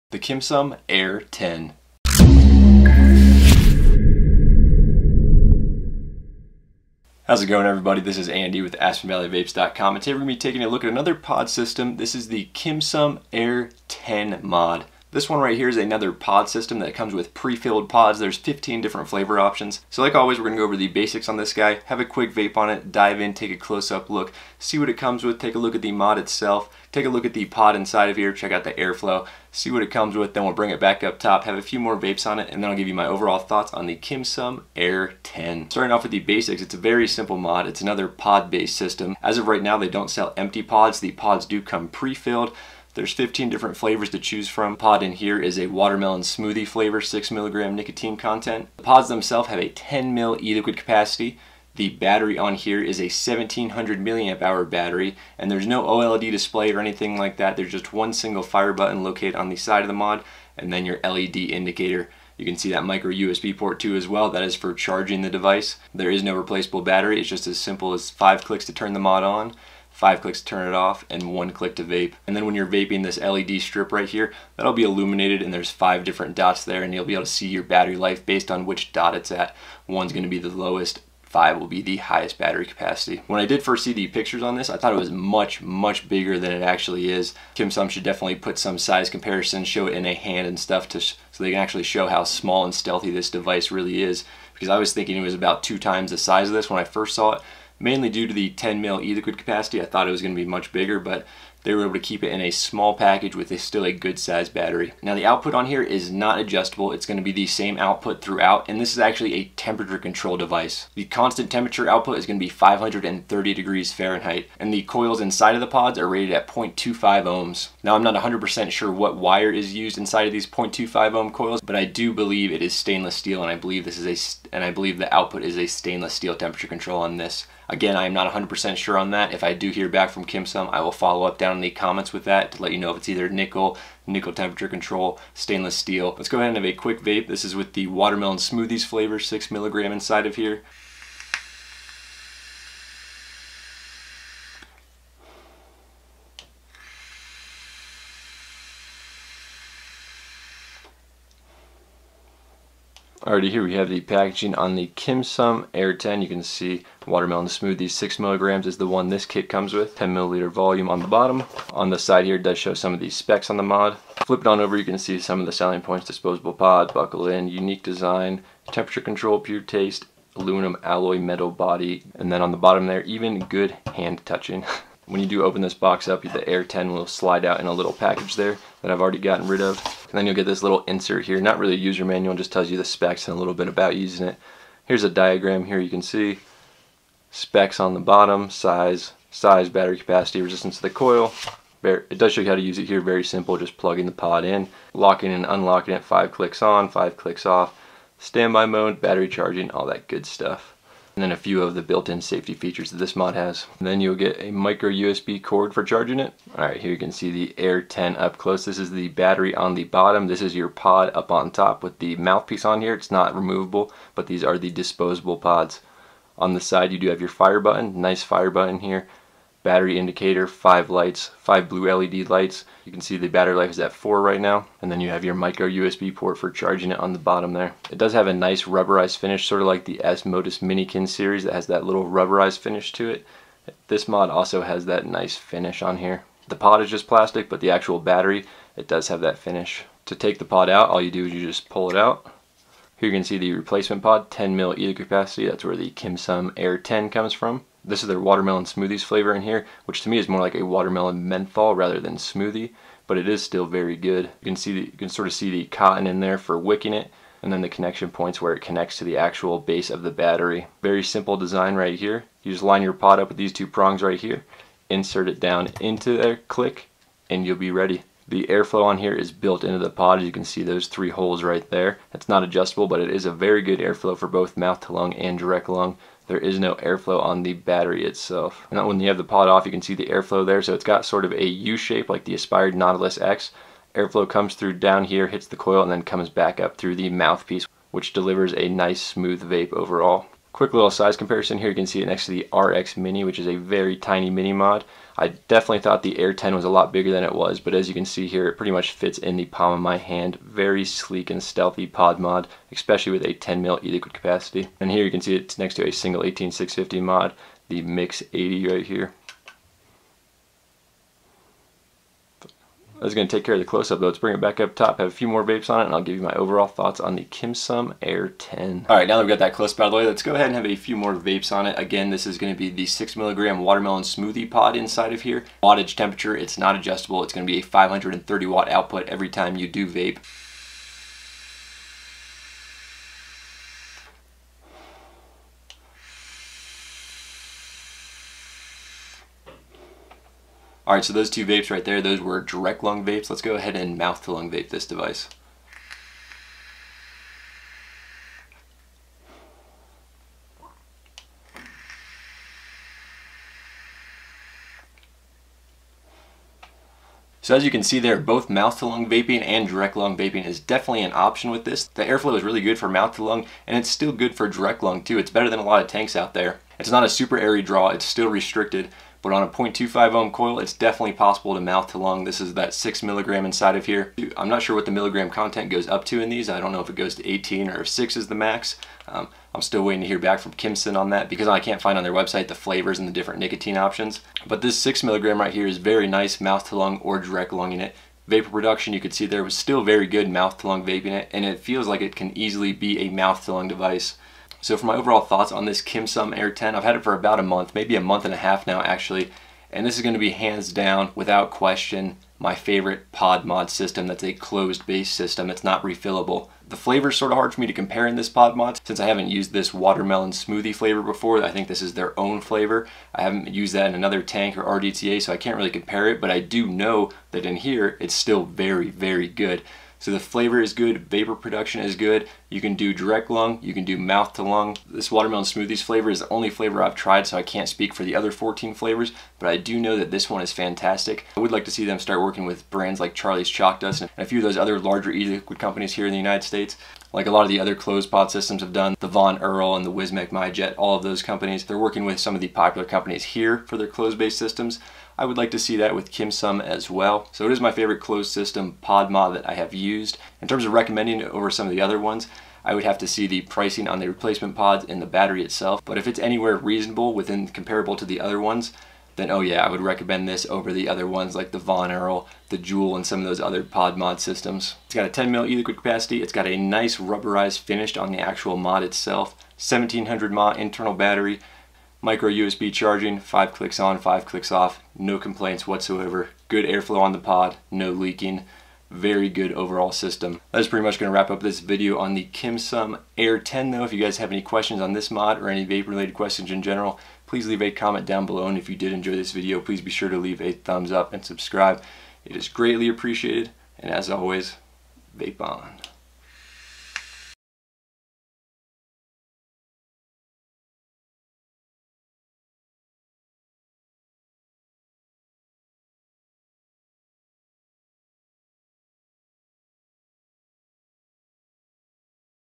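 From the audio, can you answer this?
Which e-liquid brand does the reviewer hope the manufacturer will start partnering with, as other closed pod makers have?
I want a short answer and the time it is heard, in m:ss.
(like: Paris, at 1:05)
Charlie's Chalk Dust, at 7:13.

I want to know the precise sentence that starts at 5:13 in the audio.
I was going to take care of the close-up, though.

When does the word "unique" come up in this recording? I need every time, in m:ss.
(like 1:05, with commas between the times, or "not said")
2:47.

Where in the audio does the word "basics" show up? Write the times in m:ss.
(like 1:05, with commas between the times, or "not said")
0:20, 0:36.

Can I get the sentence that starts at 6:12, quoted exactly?
This is that six milligram inside of here.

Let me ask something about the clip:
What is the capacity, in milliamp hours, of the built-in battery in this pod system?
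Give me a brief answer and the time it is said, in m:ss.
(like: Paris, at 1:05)
1700, at 0:53.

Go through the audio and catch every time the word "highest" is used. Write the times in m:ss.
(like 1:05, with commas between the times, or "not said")
1:21.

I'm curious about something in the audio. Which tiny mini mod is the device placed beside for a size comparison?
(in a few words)
RX Mini.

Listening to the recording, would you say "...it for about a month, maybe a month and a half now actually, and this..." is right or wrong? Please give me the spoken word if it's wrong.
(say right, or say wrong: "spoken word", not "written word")
right.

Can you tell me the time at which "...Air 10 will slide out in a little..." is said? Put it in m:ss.
2:56.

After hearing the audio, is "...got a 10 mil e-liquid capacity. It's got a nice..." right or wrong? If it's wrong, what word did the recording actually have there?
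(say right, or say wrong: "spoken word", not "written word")
right.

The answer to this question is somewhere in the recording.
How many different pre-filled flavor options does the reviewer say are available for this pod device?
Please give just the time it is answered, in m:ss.
0:18.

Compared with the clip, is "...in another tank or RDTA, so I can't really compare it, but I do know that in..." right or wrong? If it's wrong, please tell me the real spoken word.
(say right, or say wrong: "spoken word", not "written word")
right.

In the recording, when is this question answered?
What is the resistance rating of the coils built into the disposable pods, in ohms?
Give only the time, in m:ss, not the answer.
1:56.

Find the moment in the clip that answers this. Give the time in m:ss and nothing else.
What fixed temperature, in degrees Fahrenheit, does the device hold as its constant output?
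1:52.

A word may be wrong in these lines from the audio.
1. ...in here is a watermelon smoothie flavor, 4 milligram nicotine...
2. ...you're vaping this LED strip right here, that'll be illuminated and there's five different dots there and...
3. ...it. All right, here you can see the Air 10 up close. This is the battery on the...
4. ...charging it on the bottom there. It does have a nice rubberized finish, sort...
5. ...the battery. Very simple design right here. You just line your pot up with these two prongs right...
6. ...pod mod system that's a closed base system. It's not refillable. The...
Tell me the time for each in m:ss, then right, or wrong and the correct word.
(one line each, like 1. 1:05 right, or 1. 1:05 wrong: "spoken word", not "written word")
1. 0:45 wrong: "6", not "4"
2. 1:12 right
3. 3:26 right
4. 3:46 right
5. 4:20 right
6. 6:43 right.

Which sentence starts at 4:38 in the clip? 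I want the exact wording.
Now when you have the pod off, you can see the airflow there.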